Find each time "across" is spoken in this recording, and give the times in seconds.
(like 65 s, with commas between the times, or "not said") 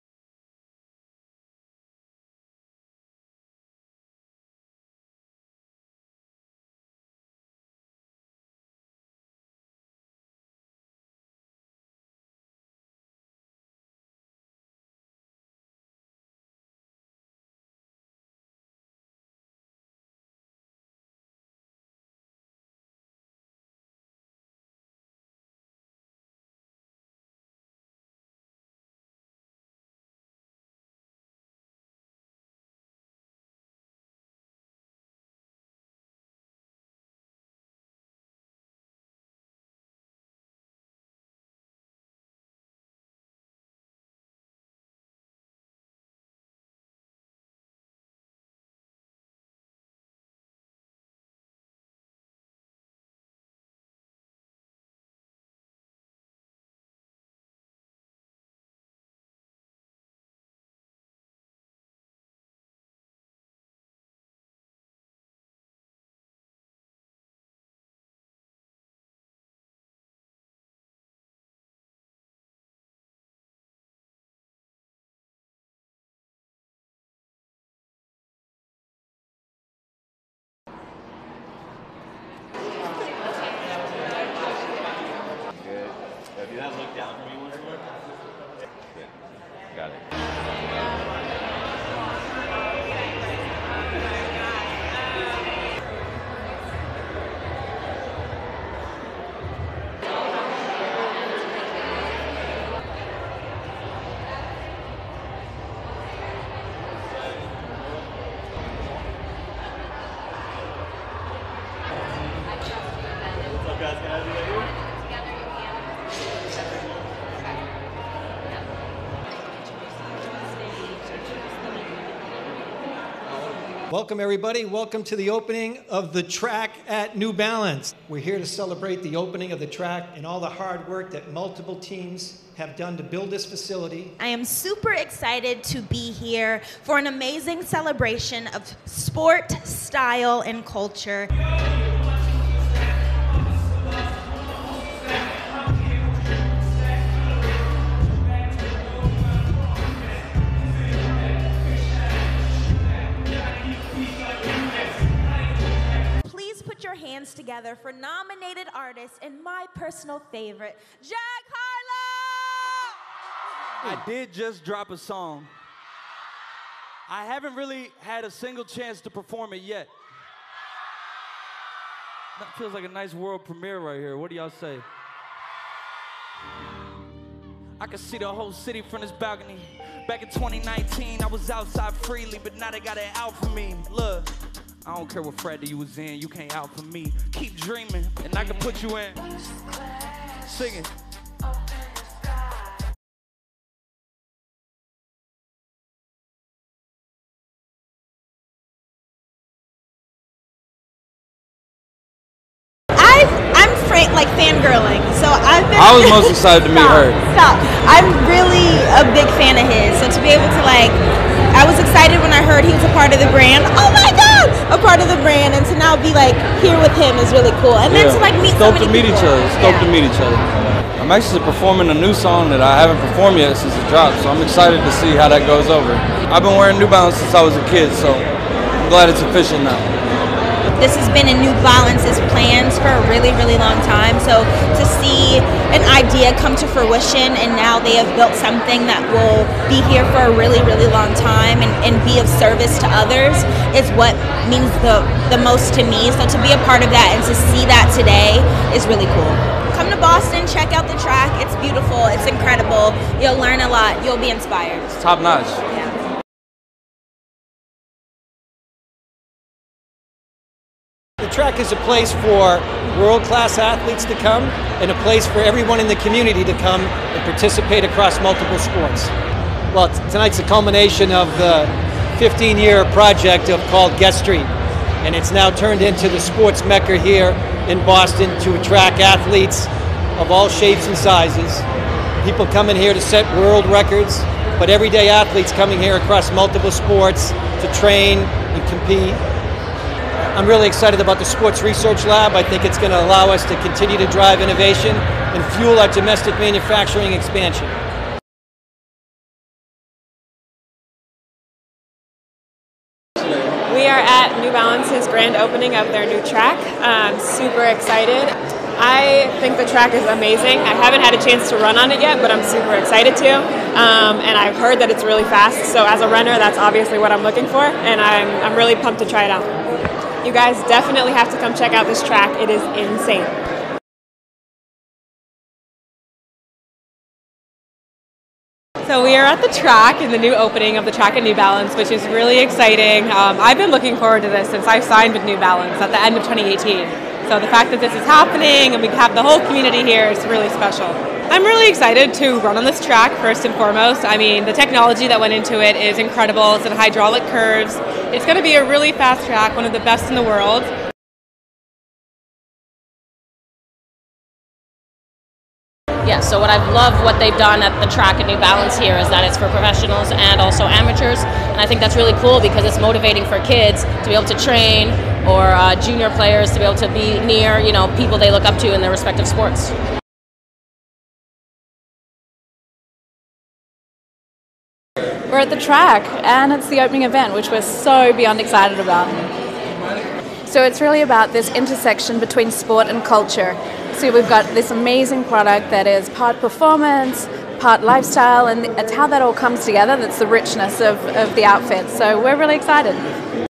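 267 s, 285 s.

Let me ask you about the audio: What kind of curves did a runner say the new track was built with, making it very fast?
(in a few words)
hydraulic curves.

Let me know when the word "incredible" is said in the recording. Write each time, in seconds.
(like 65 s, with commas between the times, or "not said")
252 s, 345 s.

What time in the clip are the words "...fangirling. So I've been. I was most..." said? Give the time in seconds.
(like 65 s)
204 s.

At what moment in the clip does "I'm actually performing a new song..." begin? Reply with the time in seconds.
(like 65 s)
221 s.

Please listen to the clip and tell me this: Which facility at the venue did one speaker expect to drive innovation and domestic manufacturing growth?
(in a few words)
Sports Research Lab.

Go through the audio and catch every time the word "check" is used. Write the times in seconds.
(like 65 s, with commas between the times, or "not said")
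250 s, 321 s.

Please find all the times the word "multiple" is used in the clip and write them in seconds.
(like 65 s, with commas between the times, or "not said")
131 s, 268 s, 286 s.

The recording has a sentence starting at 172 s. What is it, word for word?
That feels like a nice world premiere right here.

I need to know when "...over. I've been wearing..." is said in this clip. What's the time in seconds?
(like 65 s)
225 s.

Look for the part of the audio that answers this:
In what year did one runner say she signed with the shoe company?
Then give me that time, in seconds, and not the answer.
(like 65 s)
336 s.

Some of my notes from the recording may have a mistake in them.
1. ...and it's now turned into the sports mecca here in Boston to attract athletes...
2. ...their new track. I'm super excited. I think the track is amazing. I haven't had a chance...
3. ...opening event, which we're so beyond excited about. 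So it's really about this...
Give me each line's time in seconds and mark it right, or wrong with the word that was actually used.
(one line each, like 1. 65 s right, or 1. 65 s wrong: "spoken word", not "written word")
1. 275 s right
2. 305 s right
3. 376 s right.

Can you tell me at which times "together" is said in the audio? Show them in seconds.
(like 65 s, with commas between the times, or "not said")
157 s, 389 s.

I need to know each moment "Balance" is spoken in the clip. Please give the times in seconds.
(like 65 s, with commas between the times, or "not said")
127 s, 226 s, 231 s, 304 s, 331 s, 335 s, 358 s.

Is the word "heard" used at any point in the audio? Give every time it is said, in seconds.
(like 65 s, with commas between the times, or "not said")
212 s, 314 s.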